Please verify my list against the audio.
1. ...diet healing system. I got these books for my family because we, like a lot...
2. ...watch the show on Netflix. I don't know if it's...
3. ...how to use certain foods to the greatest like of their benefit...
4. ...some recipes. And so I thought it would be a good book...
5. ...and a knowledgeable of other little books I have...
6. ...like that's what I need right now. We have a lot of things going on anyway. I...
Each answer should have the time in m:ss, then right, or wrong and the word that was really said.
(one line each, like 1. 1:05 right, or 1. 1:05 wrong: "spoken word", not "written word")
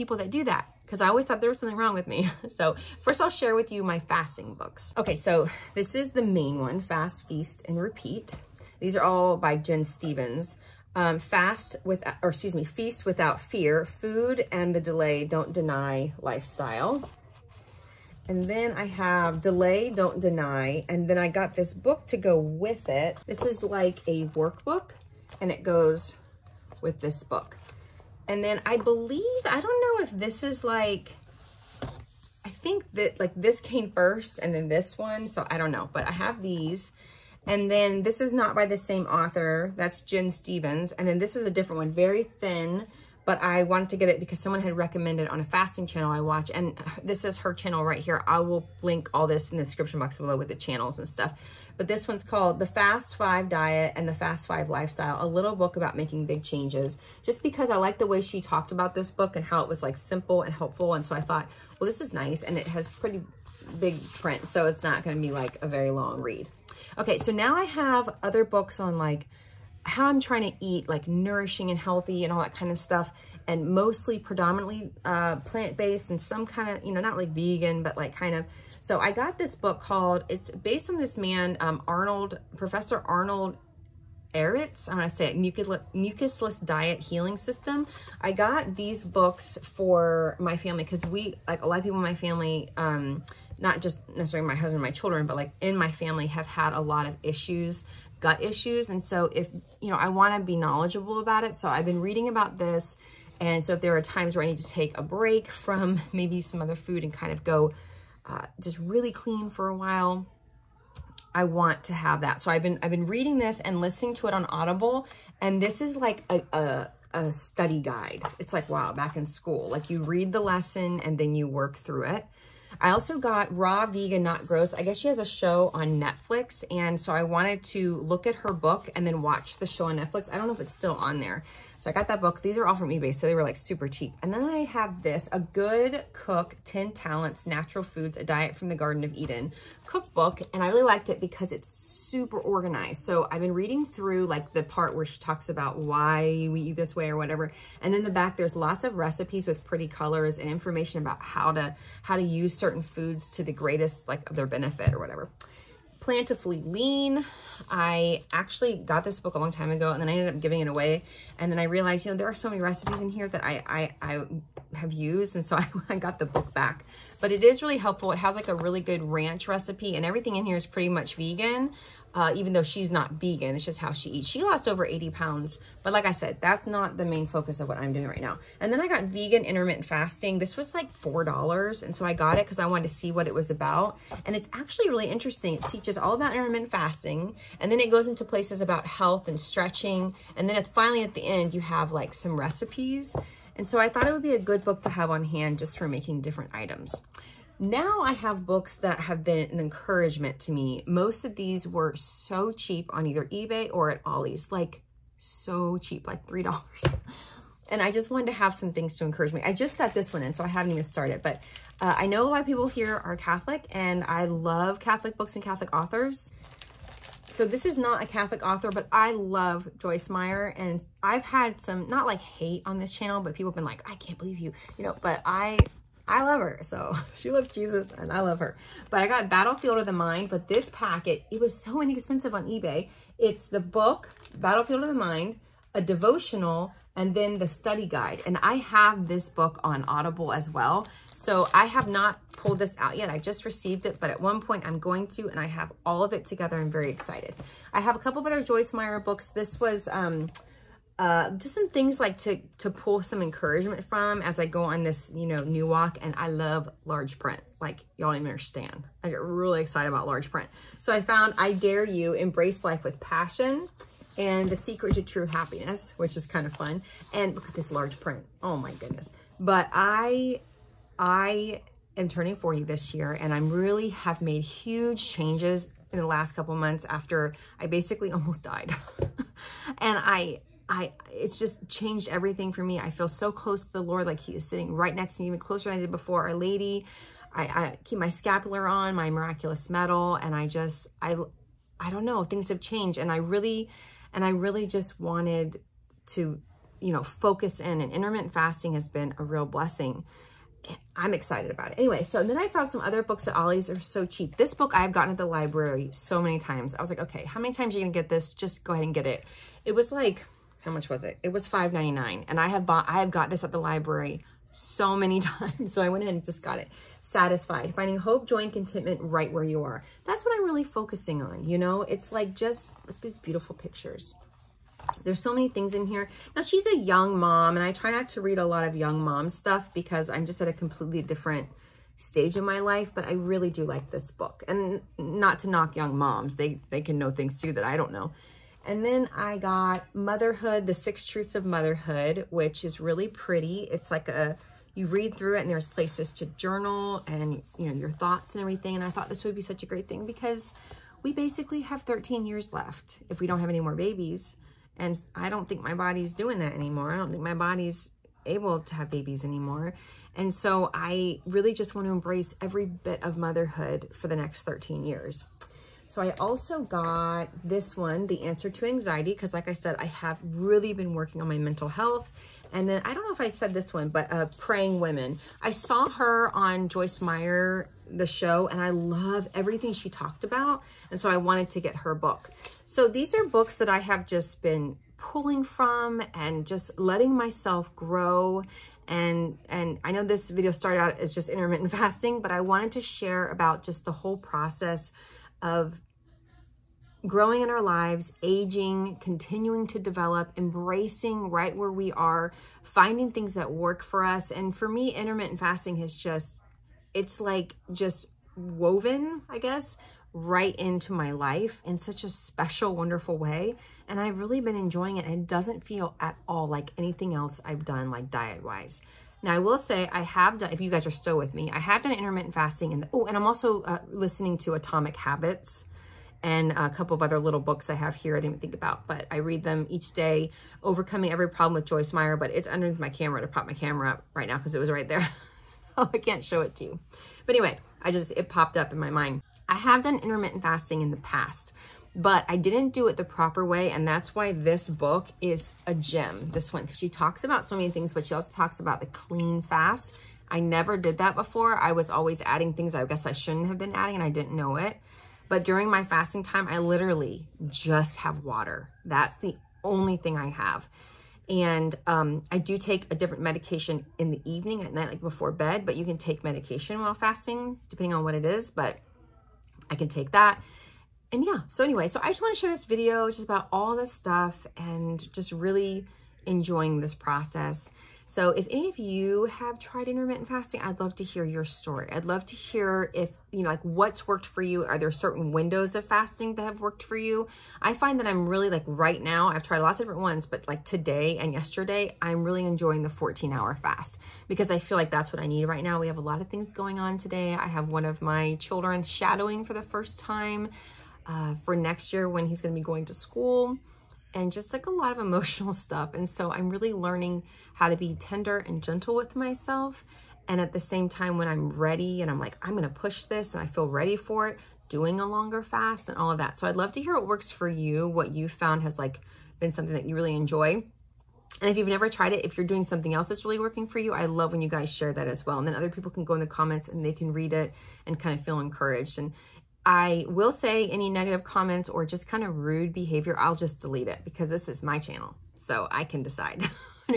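1. 1:26 right
2. 2:09 right
3. 2:32 right
4. 3:12 right
5. 7:06 wrong: "couple", not "knowledgeable"
6. 8:14 wrong: "today", not "anyway".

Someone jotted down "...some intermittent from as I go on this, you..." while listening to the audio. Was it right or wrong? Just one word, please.
wrong.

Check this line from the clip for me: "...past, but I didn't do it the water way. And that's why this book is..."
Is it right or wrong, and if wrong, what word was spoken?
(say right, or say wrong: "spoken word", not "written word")
wrong: "proper", not "water".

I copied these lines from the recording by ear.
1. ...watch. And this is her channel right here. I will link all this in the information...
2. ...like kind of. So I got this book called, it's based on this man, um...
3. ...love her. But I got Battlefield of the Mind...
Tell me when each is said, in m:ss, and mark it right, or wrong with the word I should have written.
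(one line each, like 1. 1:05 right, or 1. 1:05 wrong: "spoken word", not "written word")
1. 0:46 wrong: "description", not "information"
2. 1:17 right
3. 3:48 right.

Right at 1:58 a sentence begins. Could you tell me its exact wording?
It's like, wow, back in school, like you read the lesson and then you work through it.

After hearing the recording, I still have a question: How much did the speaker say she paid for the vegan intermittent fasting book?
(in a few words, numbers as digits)
$4.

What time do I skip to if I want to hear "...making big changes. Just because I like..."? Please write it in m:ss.
0:55.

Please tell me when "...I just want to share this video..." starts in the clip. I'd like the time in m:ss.
7:52.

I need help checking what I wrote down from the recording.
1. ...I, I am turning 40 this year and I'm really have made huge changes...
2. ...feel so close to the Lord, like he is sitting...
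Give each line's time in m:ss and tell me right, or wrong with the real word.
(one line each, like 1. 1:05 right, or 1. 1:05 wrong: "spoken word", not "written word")
1. 4:29 right
2. 4:42 right.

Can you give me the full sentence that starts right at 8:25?
And so I'm really learning how to be tender and gentle with myself.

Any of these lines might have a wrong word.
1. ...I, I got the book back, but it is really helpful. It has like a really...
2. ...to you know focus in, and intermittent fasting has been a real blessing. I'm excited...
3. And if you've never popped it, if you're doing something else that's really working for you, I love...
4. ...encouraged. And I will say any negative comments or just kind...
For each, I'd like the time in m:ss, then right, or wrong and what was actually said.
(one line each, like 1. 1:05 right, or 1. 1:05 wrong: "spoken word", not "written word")
1. 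2:45 right
2. 4:56 right
3. 8:41 wrong: "tried", not "popped"
4. 8:48 right.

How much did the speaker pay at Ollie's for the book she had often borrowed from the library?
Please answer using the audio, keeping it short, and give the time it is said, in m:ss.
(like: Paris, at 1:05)
$5.99, at 5:11.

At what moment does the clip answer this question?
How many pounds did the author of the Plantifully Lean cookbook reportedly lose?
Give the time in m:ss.
2:54.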